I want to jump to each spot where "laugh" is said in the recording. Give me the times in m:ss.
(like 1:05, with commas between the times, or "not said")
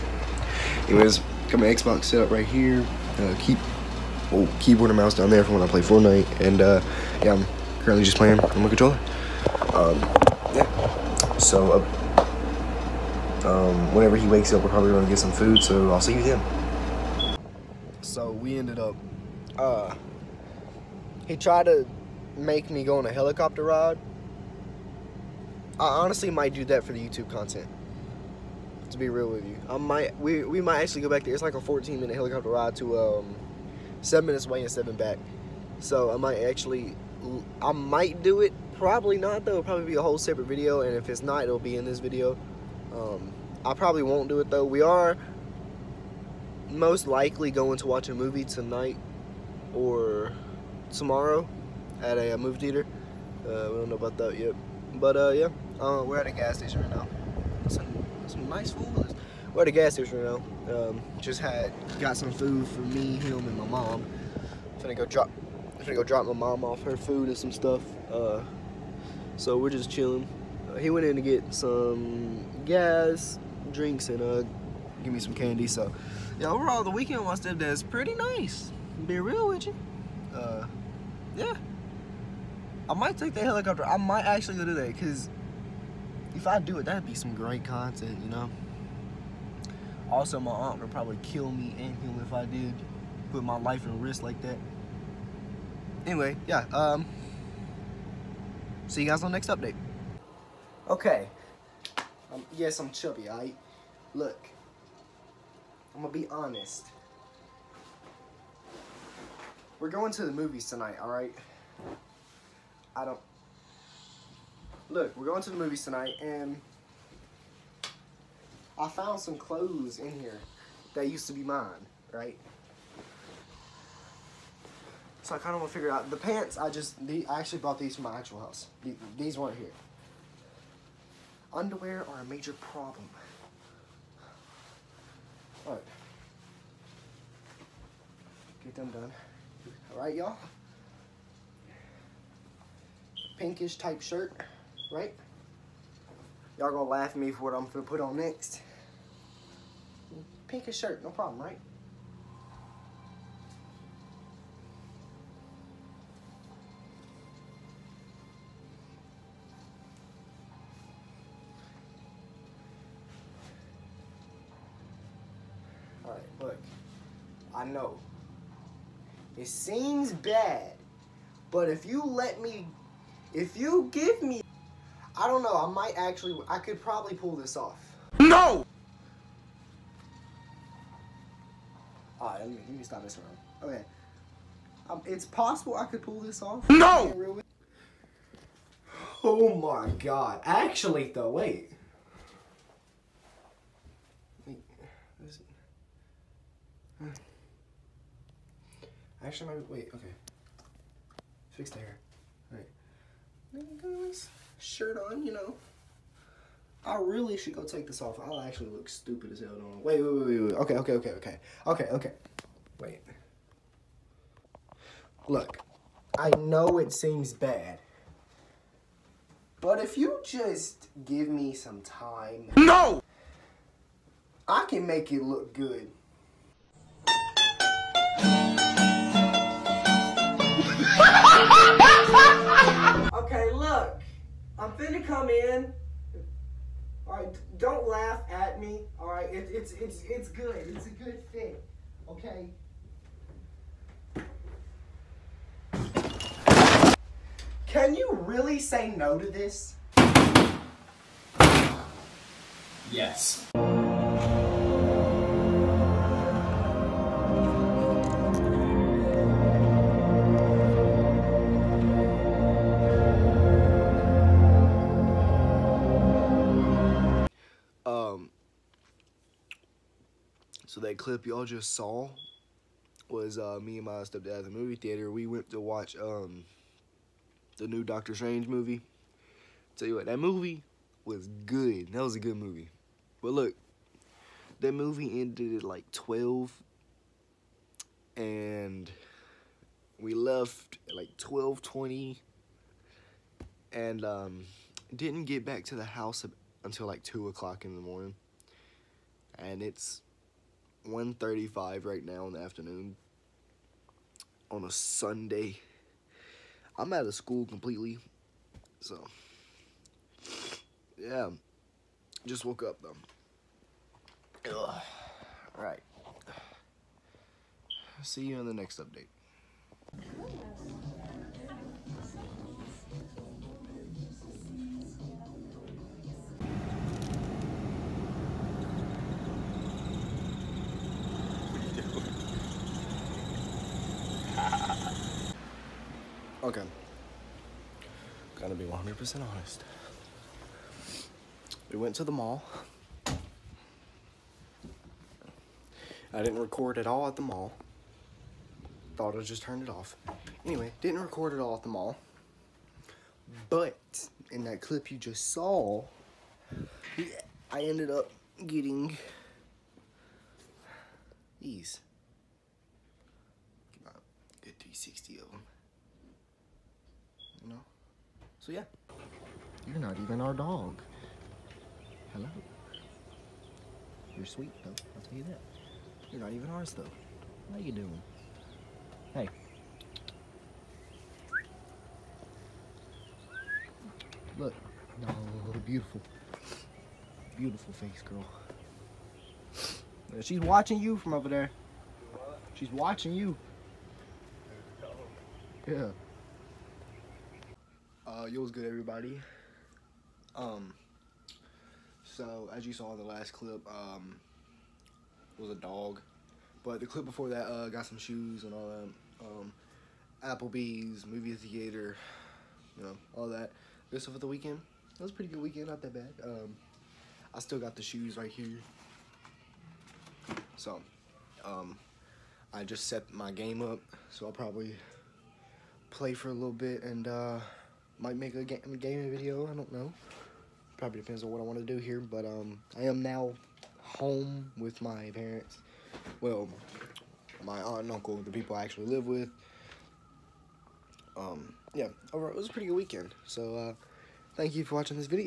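2:26, 3:57.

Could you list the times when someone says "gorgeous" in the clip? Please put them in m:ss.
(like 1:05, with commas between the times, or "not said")
not said.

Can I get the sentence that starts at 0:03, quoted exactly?
Uh, keep oh, keyboard and mouse down there from when I play Fortnite.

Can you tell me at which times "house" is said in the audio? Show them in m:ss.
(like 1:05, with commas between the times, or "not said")
2:08, 4:55.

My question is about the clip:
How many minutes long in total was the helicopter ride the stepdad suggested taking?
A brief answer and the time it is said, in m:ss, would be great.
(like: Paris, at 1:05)
14 minutes, at 0:31.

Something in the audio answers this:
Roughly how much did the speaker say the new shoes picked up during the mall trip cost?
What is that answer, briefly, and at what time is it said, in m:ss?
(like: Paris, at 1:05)
360, at 6:04.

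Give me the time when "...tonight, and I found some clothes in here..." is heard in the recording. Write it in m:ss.
1:55.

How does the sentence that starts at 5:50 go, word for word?
Anyway, didn't record at all at the mall.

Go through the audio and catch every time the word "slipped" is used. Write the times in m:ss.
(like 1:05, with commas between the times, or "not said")
not said.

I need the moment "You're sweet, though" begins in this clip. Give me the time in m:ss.
6:14.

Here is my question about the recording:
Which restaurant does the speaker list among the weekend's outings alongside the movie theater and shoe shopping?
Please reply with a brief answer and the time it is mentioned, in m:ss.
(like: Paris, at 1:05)
Applebee's, at 6:50.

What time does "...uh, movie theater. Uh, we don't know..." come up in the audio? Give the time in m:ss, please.
0:52.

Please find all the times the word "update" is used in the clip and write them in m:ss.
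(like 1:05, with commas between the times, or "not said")
1:39, 5:18.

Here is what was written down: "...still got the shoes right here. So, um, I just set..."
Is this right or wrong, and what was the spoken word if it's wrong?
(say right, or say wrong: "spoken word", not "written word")
right.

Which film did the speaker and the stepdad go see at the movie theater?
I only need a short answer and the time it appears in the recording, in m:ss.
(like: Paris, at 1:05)
Doctor Strange, at 4:37.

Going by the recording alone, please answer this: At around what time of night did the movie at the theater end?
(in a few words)
12.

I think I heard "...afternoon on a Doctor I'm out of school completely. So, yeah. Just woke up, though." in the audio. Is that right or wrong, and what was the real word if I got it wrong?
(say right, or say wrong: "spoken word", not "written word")
wrong: "Sunday", not "Doctor".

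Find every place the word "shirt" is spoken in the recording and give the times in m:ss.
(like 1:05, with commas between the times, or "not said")
2:24, 2:30, 3:24.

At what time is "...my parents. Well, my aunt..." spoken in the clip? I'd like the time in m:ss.
7:14.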